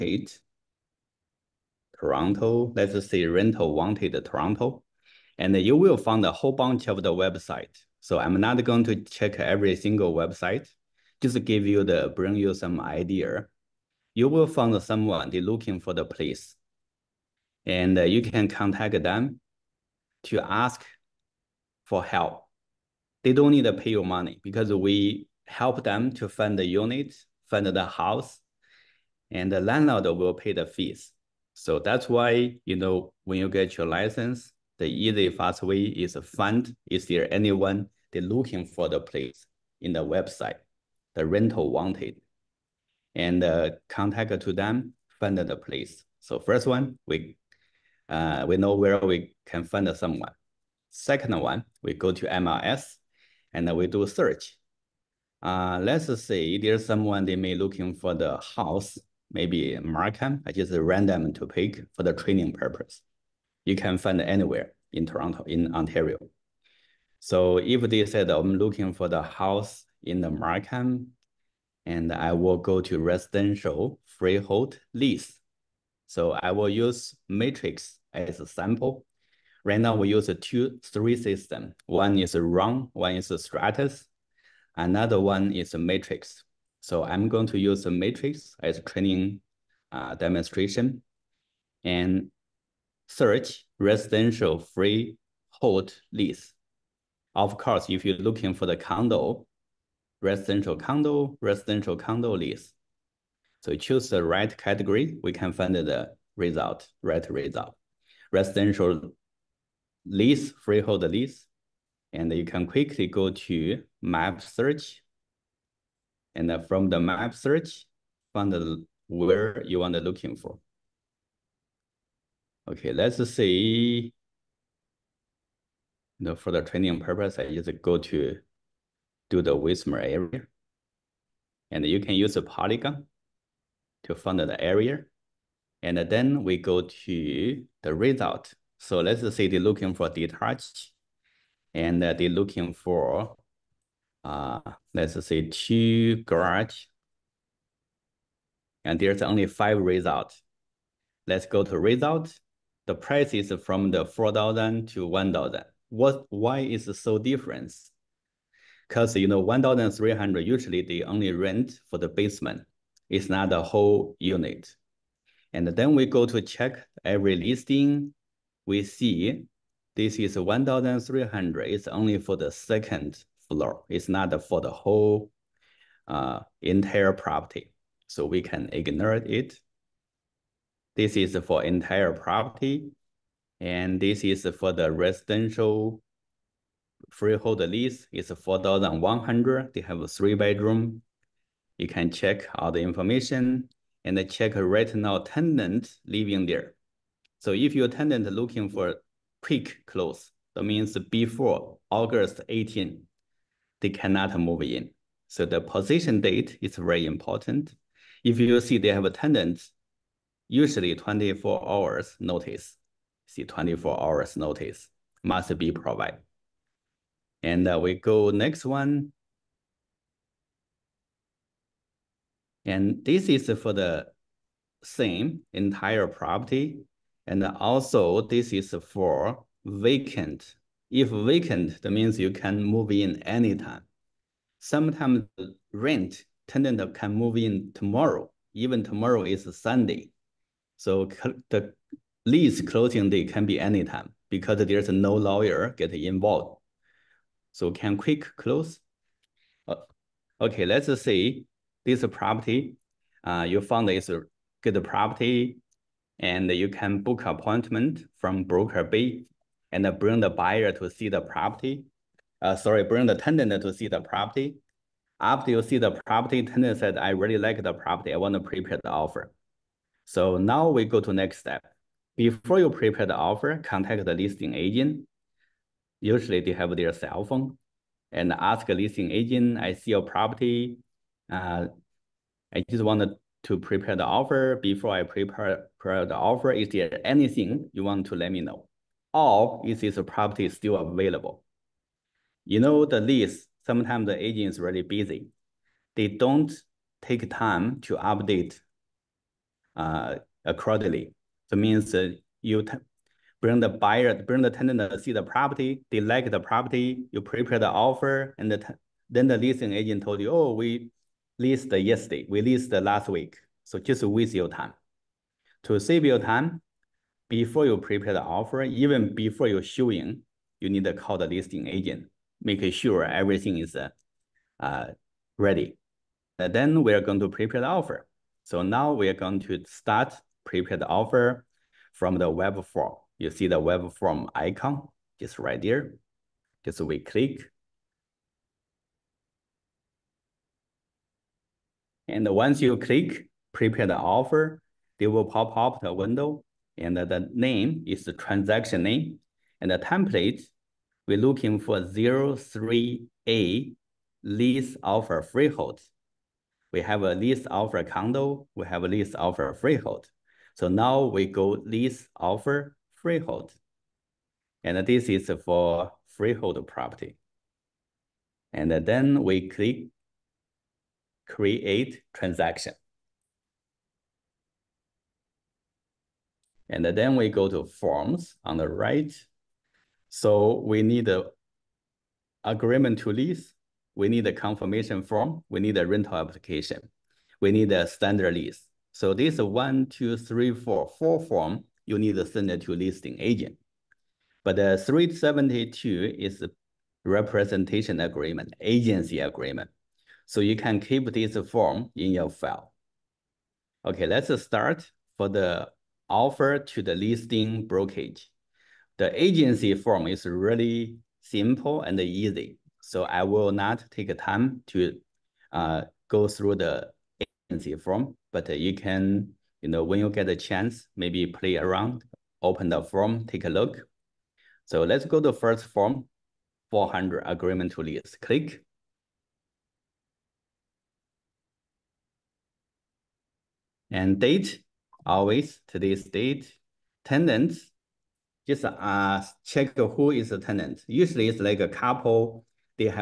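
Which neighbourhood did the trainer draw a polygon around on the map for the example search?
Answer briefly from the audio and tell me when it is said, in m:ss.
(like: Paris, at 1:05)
Wismer, at 2:09.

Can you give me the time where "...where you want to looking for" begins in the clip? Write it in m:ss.
1:59.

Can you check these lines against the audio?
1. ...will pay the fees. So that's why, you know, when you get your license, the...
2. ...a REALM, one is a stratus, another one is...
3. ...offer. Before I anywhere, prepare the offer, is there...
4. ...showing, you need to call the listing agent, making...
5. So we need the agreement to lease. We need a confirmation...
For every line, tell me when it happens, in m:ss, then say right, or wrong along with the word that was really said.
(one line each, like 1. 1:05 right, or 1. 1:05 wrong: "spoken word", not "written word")
1. 0:30 right
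2. 1:22 right
3. 4:44 wrong: "prepare", not "anywhere"
4. 5:19 right
5. 6:20 right.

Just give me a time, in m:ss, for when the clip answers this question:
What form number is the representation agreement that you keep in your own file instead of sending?
6:34.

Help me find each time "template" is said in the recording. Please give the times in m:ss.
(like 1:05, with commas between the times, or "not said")
5:49.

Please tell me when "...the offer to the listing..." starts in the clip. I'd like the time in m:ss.
6:45.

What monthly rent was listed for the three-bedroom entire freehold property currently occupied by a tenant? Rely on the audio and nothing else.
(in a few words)
4,100.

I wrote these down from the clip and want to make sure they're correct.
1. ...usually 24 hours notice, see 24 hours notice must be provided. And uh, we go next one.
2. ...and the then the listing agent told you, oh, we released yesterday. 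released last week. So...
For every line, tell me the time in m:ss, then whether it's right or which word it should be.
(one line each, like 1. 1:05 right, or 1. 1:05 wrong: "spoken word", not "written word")
1. 3:30 right
2. 5:08 right.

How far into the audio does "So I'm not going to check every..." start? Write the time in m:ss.
0:07.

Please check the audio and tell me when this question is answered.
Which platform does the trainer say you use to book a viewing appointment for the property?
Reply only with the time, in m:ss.
4:18.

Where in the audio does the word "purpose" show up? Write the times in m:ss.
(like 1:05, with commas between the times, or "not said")
1:02, 2:06.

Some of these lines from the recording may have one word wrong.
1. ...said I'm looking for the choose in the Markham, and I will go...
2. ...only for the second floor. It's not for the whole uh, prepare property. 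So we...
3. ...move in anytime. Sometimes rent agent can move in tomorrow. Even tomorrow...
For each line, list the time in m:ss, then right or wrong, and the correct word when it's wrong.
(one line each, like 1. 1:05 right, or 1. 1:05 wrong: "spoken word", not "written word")
1. 1:08 wrong: "house", not "choose"
2. 2:51 wrong: "entire", not "prepare"
3. 3:52 wrong: "tenant", not "agent".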